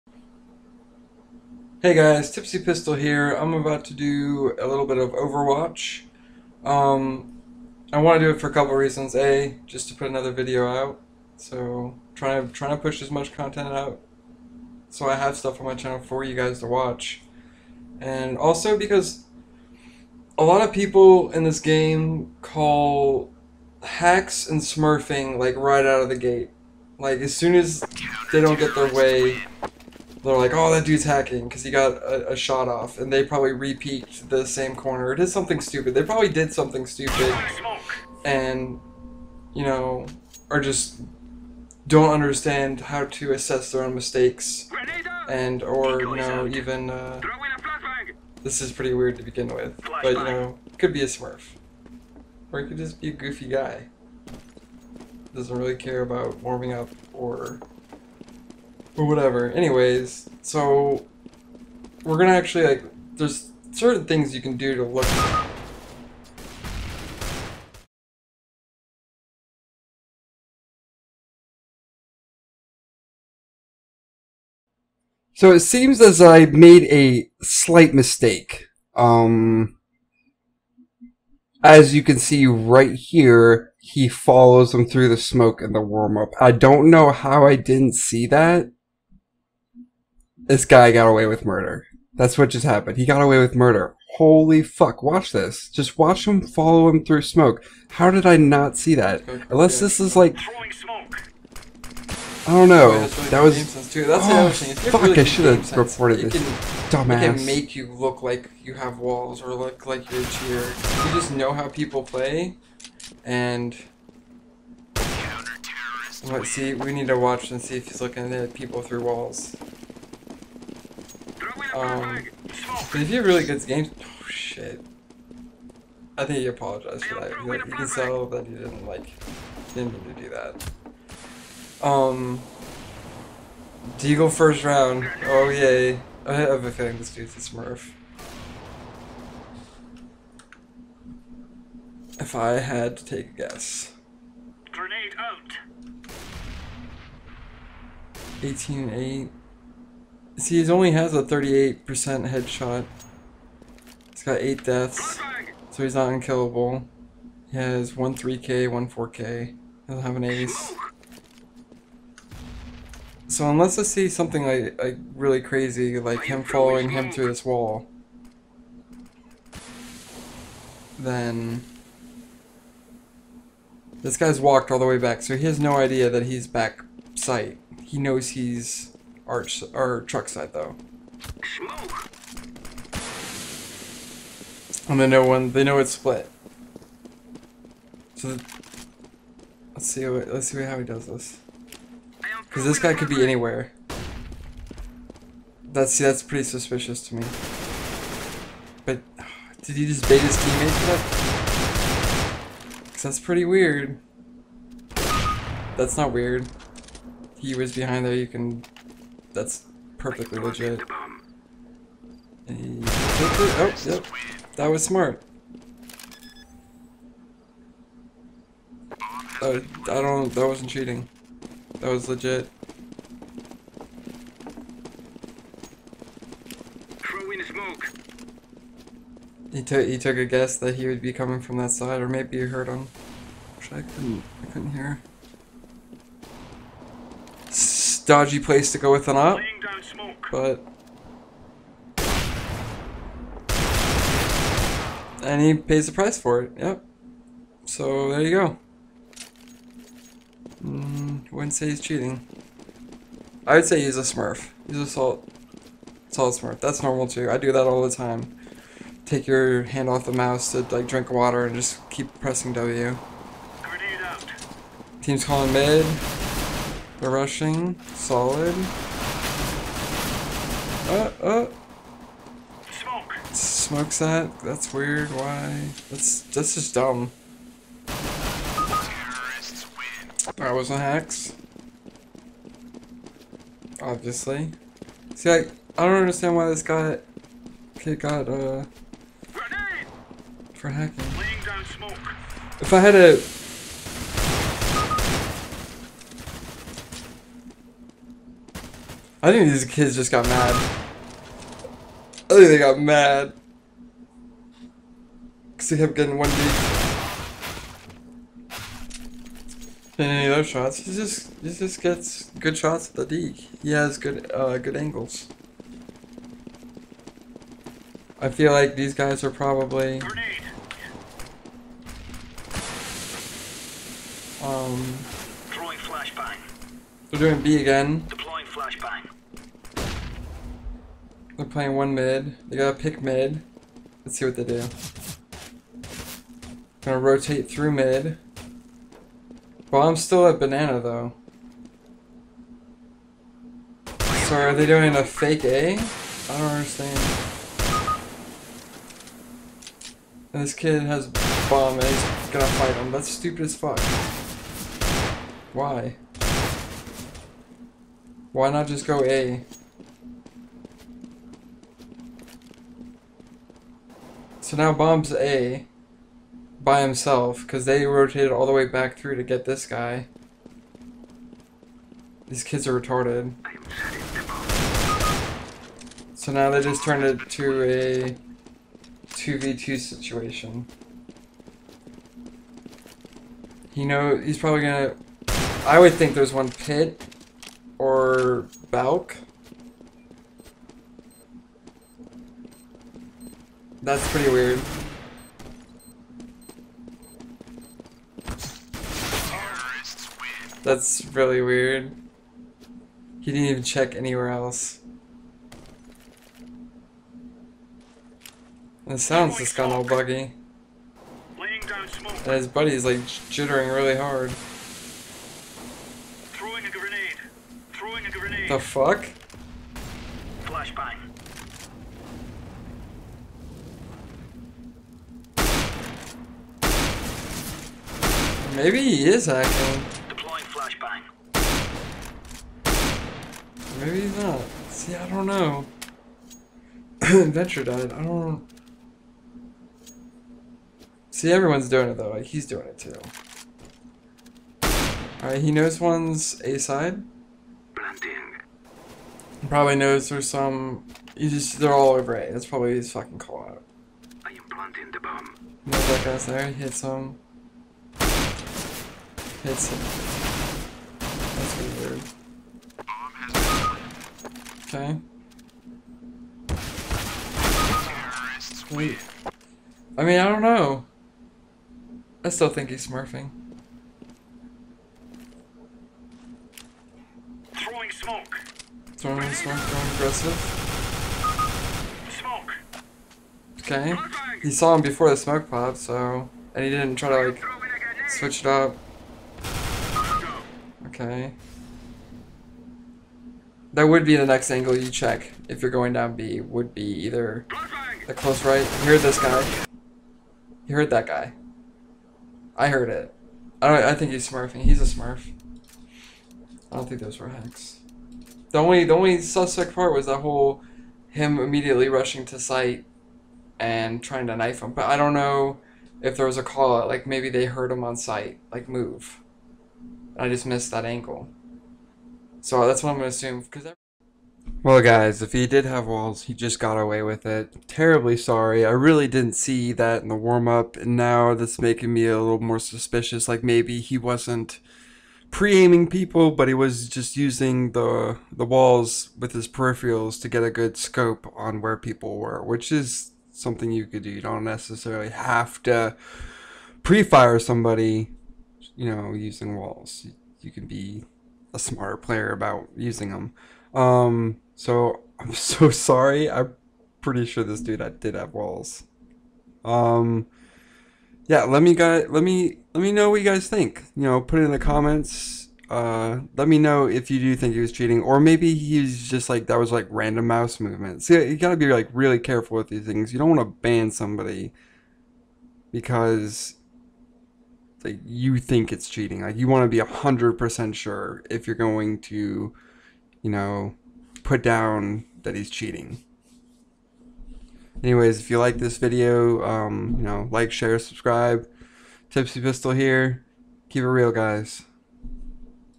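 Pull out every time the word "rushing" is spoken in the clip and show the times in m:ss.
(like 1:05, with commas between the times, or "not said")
4:27, 8:31.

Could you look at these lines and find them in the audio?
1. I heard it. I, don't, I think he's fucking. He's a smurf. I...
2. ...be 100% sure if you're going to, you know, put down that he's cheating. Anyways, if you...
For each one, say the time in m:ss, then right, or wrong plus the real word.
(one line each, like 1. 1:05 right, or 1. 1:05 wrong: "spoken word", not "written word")
1. 8:22 wrong: "smurfing", not "fucking"
2. 9:39 right.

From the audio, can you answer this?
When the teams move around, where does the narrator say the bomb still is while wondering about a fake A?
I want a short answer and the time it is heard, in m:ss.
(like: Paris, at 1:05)
banana, at 5:40.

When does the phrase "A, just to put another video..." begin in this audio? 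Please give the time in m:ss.
0:09.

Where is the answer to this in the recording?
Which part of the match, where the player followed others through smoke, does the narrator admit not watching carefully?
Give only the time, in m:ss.
1:25.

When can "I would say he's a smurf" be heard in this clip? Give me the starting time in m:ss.
4:13.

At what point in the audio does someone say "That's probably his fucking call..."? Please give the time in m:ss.
7:32.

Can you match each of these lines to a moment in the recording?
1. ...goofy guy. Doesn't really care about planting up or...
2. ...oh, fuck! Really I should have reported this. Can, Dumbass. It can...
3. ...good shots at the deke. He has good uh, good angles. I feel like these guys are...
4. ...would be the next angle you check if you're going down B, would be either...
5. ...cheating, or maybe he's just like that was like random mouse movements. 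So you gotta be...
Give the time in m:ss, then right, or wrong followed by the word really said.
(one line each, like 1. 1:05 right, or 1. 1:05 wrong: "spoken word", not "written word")
1. 0:53 wrong: "warming", not "planting"
2. 1:44 right
3. 5:12 right
4. 8:13 right
5. 9:27 right.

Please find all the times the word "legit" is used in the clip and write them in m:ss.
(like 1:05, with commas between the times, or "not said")
3:30, 3:42.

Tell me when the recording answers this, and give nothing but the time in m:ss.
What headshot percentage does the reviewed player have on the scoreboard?
2:31.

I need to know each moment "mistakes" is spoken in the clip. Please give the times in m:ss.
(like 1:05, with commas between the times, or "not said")
0:43, 1:17.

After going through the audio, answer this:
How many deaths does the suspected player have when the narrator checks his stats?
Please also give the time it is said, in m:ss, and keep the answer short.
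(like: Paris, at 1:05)
8, at 2:34.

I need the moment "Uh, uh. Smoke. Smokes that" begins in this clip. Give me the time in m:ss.
4:30.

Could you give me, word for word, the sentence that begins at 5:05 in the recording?
Because he kept getting one deke.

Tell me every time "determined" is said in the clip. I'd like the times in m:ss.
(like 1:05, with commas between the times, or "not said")
not said.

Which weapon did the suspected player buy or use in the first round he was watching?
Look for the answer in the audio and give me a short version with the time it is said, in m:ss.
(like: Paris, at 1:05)
Deagle, at 2:13.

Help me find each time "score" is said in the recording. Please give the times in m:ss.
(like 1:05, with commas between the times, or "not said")
not said.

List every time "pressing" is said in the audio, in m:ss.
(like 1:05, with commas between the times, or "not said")
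4:22.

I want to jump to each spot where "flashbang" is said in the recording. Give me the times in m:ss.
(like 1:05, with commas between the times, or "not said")
7:00, 7:10.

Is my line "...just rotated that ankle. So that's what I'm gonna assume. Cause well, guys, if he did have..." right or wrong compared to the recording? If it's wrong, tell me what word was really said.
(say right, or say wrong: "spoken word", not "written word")
wrong: "missed", not "rotated".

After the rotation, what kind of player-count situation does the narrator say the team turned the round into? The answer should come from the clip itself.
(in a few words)
2v2.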